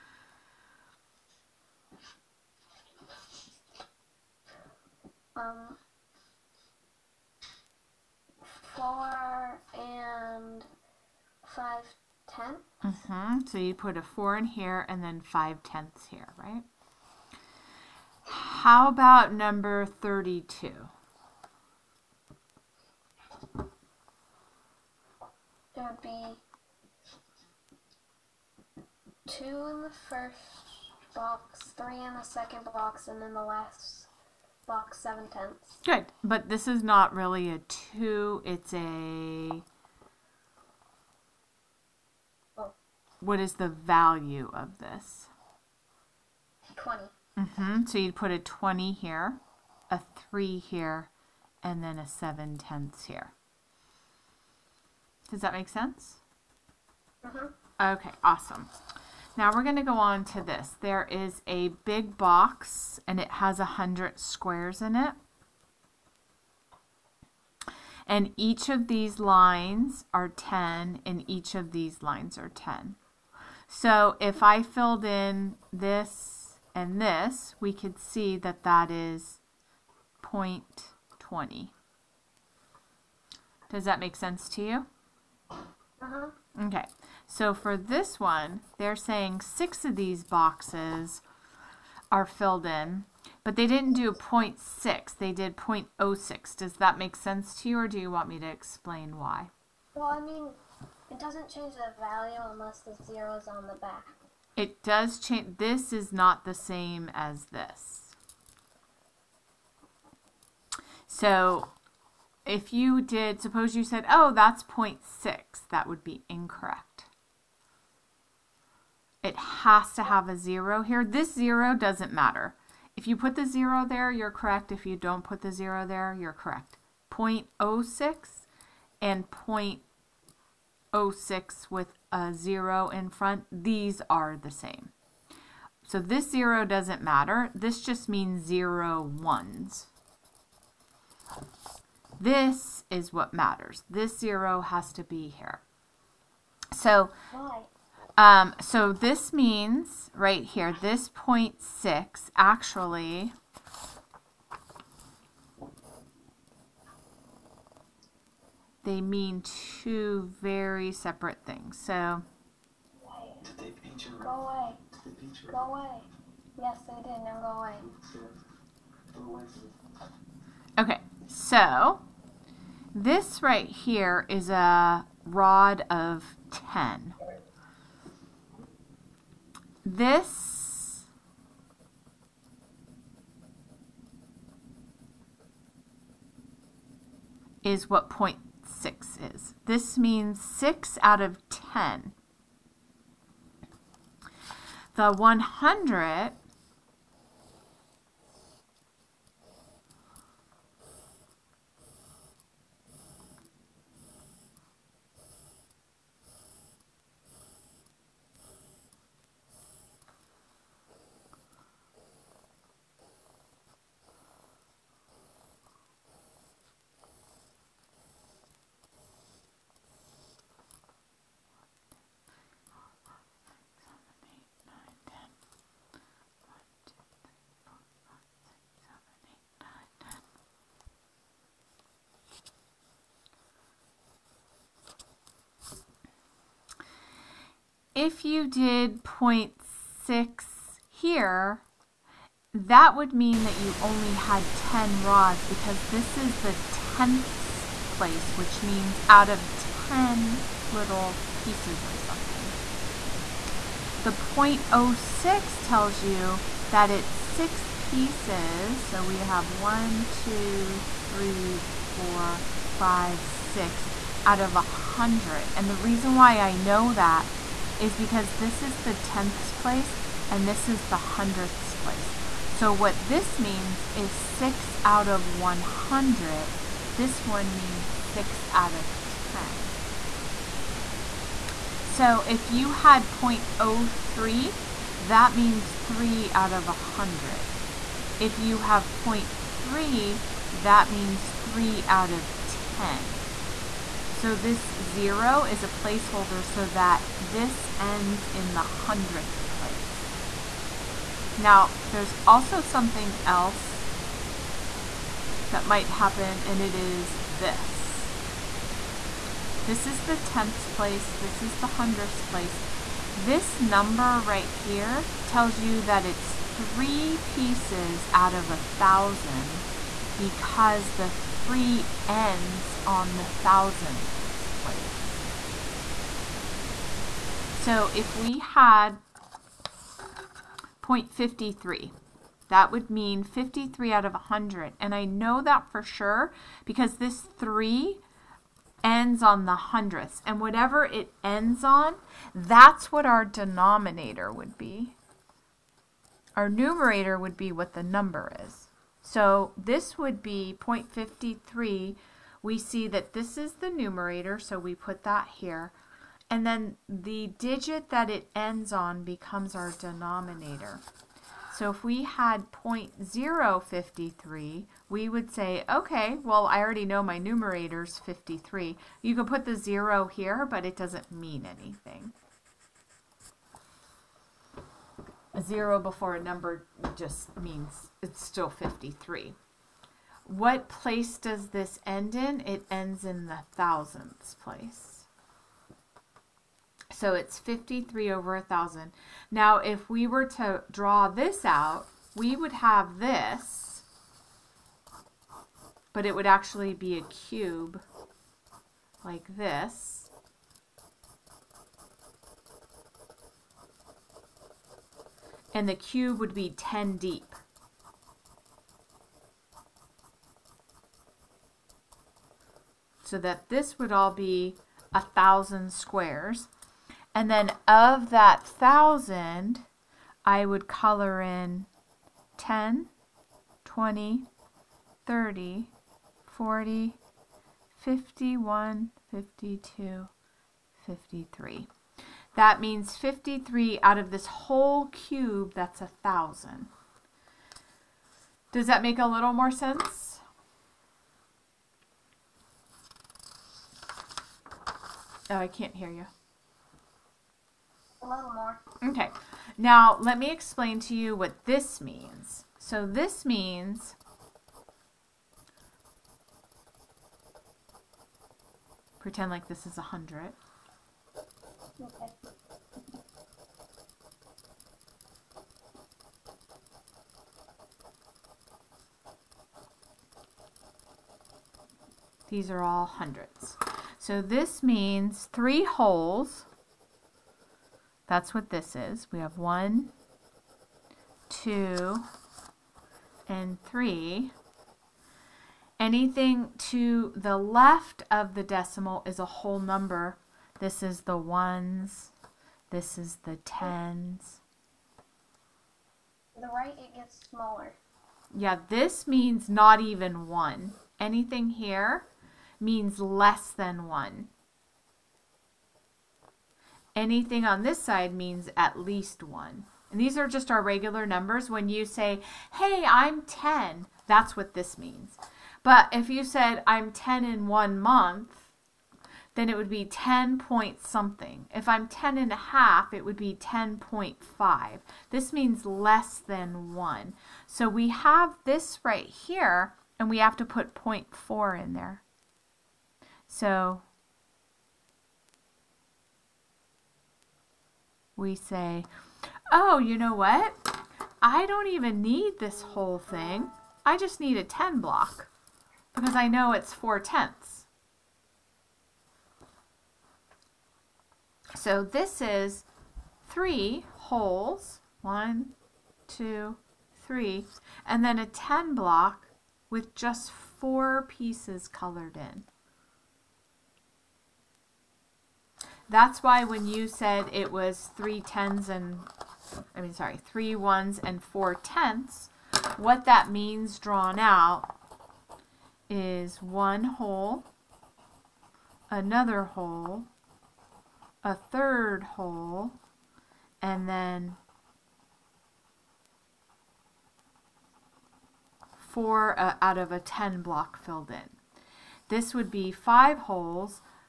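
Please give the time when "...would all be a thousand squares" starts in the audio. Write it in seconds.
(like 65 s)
413 s.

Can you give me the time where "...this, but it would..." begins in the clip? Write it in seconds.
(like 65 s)
392 s.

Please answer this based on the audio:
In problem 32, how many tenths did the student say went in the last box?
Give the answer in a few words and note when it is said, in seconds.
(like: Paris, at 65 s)
7 tenths, at 34 s.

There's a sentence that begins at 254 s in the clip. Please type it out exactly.
The 0.06 tells you that it's six pieces.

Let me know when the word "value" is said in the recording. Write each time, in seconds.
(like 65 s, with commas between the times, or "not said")
43 s, 101 s.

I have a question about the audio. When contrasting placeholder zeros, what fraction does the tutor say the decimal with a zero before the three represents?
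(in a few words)
3 out of 100.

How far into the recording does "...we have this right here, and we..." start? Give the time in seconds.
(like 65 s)
527 s.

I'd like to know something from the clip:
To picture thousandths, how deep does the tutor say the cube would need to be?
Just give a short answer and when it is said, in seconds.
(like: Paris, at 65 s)
10 deep, at 406 s.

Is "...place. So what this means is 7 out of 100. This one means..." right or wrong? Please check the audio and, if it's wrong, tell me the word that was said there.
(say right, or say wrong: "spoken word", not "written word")
wrong: "6", not "7".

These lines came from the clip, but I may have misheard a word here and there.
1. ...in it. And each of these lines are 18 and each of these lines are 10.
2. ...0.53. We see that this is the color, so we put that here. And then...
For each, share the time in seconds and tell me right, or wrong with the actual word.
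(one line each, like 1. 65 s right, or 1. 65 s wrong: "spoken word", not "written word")
1. 64 s wrong: "10", not "18"
2. 350 s wrong: "numerator", not "color".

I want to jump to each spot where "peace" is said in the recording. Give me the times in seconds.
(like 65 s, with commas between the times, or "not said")
not said.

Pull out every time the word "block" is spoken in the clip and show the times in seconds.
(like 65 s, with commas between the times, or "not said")
544 s, 558 s, 590 s.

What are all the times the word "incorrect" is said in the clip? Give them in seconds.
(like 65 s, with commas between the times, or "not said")
116 s.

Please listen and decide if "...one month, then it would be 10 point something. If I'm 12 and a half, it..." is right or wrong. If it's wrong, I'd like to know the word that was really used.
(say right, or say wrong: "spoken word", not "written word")
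wrong: "10", not "12".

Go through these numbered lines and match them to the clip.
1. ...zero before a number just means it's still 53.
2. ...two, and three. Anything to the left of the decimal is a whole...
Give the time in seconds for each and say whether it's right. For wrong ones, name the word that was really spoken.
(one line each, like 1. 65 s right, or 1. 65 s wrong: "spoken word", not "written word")
1. 375 s right
2. 481 s right.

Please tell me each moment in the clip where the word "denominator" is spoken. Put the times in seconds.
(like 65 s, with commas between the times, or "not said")
343 s, 359 s.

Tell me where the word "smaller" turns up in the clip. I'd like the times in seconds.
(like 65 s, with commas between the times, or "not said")
497 s.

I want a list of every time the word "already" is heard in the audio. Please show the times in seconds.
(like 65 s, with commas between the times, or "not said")
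366 s.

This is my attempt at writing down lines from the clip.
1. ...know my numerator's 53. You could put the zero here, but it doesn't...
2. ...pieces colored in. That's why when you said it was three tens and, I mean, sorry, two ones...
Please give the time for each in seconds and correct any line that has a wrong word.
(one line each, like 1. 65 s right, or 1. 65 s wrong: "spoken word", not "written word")
1. 366 s right
2. 561 s wrong: "three", not "two".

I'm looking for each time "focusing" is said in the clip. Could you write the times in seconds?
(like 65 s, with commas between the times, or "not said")
not said.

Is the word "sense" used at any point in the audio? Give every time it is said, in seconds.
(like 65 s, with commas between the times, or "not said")
55 s, 84 s, 97 s, 439 s.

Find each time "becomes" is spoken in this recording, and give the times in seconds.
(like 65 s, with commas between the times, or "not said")
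359 s.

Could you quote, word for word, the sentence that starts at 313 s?
This number right here tells you that it's three pieces out of a thousand because the three ends on the thousandths place.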